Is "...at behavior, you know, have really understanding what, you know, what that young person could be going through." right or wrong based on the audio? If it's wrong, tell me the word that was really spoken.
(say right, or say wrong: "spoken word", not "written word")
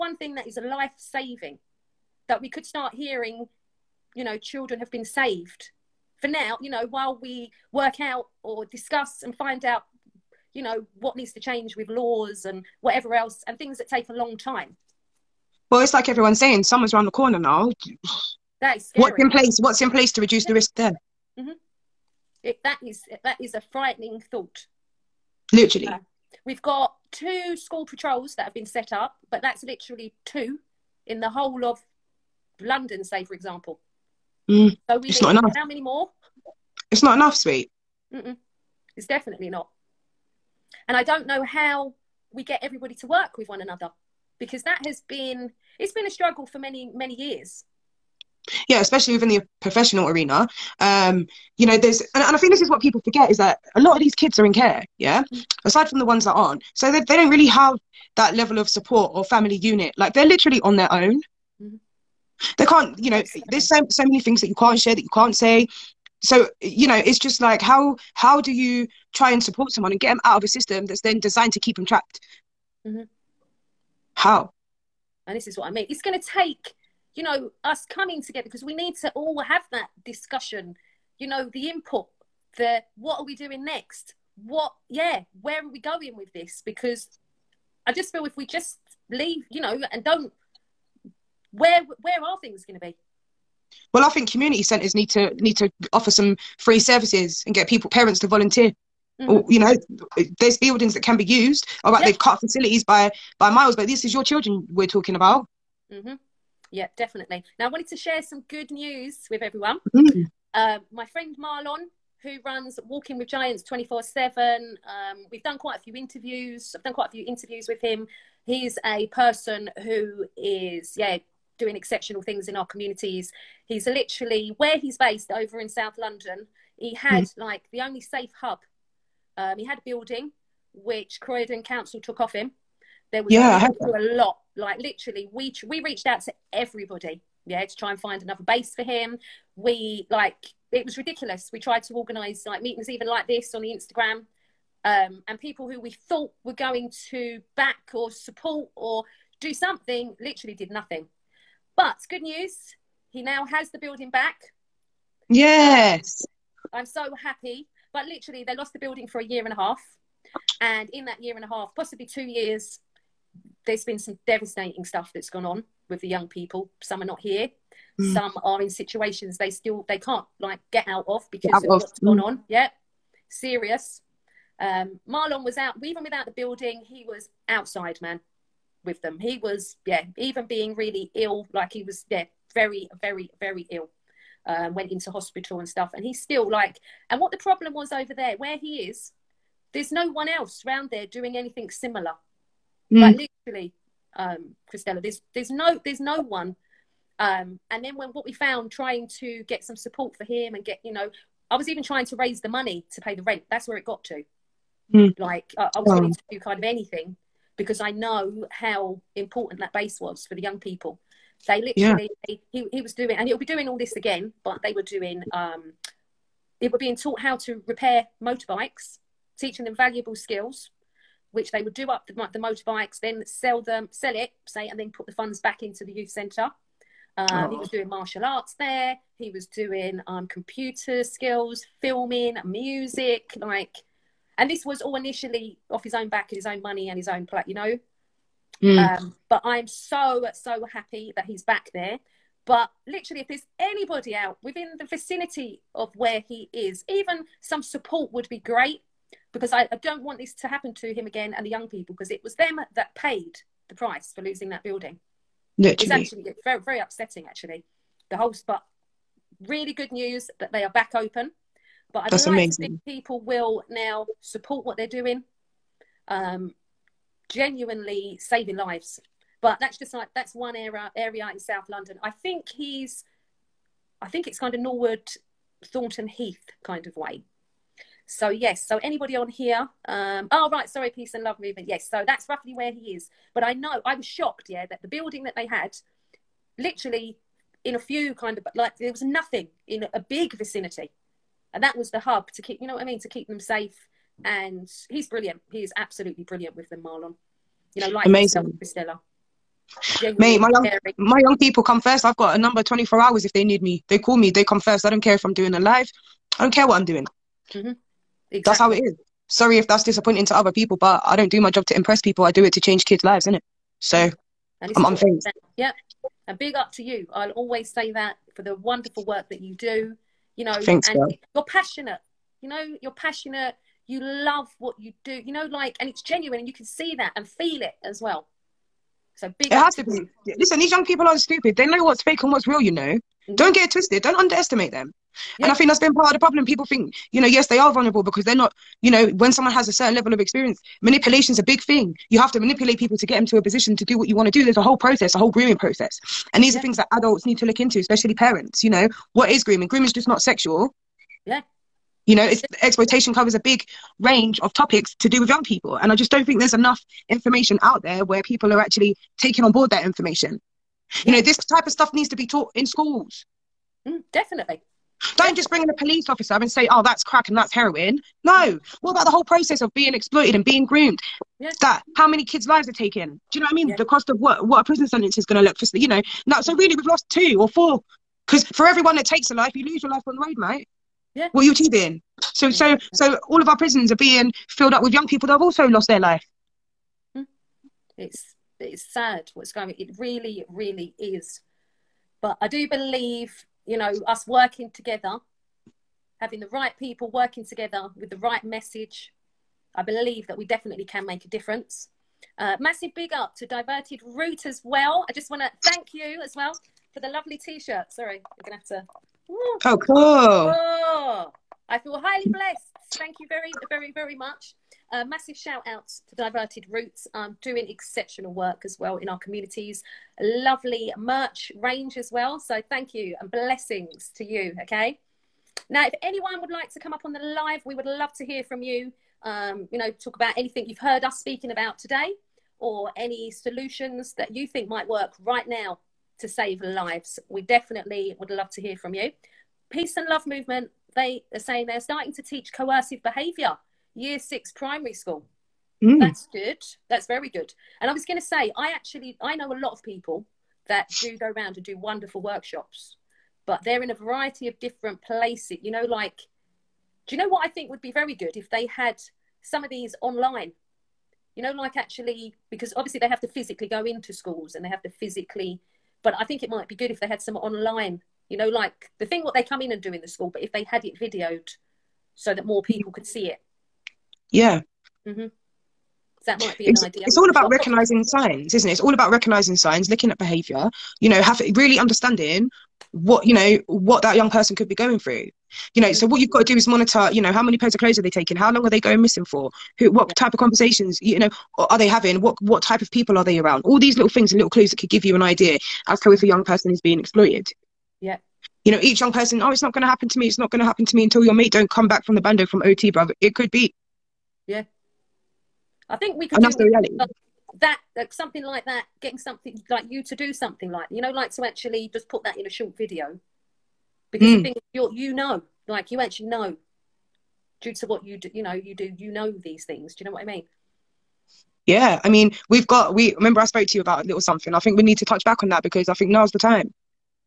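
right.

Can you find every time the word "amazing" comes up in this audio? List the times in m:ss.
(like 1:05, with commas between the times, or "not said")
4:22, 4:58.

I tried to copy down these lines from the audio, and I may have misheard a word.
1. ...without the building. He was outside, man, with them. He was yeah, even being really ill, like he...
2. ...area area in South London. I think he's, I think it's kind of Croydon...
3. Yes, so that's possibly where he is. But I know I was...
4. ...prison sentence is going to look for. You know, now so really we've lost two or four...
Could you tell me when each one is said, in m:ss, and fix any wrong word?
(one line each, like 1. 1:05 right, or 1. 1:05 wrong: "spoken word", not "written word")
1. 2:56 right
2. 4:30 wrong: "Norwood", not "Croydon"
3. 4:41 wrong: "roughly", not "possibly"
4. 6:14 right.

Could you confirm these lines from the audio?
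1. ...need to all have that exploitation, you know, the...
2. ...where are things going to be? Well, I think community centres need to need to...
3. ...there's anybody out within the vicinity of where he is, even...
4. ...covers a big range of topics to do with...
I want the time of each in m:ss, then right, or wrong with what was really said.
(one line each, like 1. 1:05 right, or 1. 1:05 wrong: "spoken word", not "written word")
1. 1:18 wrong: "discussion", not "exploitation"
2. 1:32 right
3. 4:03 right
4. 5:53 right.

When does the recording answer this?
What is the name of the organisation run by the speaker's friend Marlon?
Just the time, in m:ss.
1:52.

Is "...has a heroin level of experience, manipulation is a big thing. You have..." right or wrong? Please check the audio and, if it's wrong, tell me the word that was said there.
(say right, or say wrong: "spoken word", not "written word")
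wrong: "certain", not "heroin".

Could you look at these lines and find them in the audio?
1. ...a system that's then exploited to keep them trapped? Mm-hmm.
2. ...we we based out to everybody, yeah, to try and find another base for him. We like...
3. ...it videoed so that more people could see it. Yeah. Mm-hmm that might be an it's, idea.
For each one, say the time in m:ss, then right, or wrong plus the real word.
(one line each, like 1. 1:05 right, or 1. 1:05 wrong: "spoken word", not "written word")
1. 1:10 wrong: "designed", not "exploited"
2. 2:15 wrong: "reached", not "based"
3. 7:50 right.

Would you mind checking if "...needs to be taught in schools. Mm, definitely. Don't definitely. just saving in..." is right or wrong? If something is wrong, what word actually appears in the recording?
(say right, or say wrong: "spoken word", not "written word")
wrong: "bring", not "saving".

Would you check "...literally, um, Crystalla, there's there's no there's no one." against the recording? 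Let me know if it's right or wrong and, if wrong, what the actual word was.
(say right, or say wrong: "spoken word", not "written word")
right.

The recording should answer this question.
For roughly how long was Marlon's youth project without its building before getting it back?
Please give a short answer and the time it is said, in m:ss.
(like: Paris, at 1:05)
A year and a half, at 2:39.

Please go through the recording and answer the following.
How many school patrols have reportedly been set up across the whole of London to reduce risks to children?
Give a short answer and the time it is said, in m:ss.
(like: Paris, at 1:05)
2, at 0:27.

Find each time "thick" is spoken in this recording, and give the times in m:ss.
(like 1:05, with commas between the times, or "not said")
not said.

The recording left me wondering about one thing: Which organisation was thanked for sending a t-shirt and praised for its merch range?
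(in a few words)
Diverted Roots.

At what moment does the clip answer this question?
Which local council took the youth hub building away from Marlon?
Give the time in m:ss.
2:11.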